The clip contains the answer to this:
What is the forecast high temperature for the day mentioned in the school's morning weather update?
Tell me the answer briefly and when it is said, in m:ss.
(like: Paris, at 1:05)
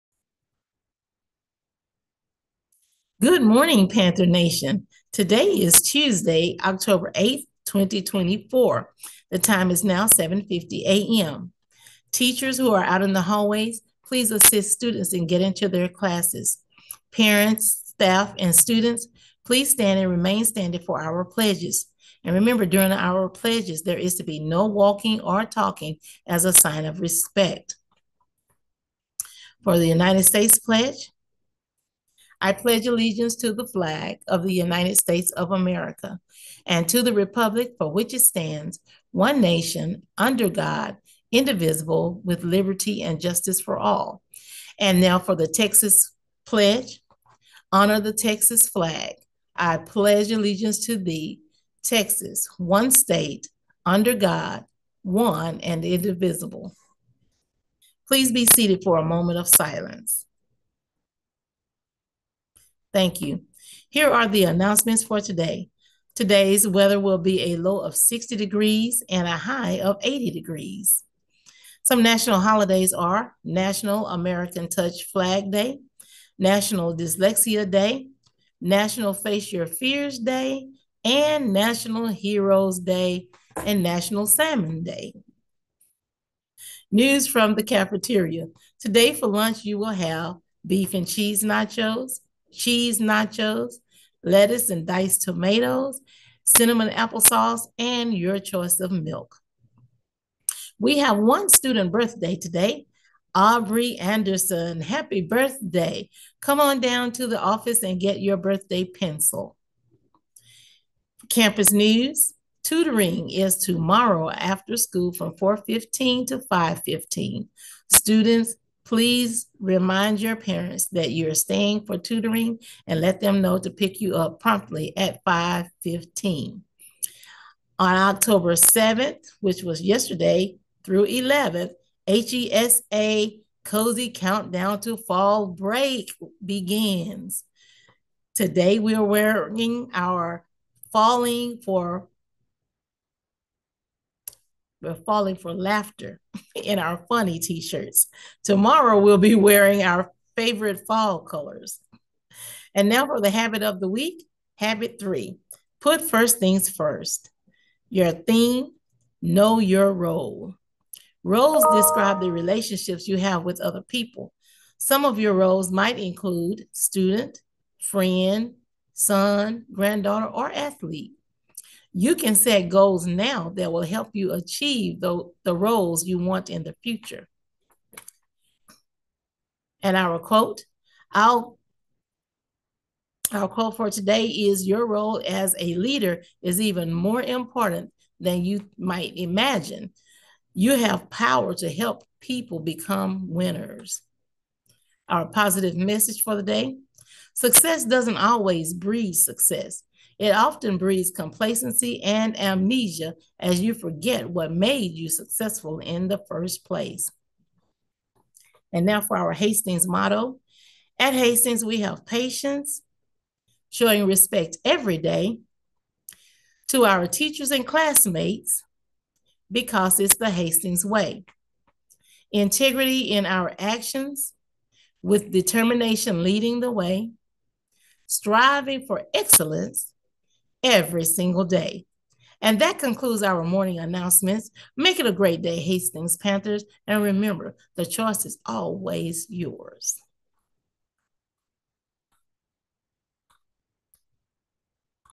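80 degrees, at 1:09.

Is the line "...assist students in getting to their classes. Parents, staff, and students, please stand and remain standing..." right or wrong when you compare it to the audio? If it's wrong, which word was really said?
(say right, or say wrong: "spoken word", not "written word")
right.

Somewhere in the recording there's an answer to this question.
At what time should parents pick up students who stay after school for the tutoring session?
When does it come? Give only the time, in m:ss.
2:04.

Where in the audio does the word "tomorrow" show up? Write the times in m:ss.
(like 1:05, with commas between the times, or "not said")
1:53, 2:28.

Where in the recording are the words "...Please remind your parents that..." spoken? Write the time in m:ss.
1:58.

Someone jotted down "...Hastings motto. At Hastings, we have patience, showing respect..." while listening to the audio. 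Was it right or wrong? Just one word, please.
right.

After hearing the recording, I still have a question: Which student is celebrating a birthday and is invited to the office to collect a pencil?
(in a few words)
Aubrey Anderson.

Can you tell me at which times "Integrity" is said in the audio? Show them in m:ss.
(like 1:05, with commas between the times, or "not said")
3:42.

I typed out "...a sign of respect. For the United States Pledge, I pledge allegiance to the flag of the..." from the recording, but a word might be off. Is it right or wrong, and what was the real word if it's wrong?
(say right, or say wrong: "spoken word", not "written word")
right.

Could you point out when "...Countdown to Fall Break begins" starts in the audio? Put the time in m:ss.
2:14.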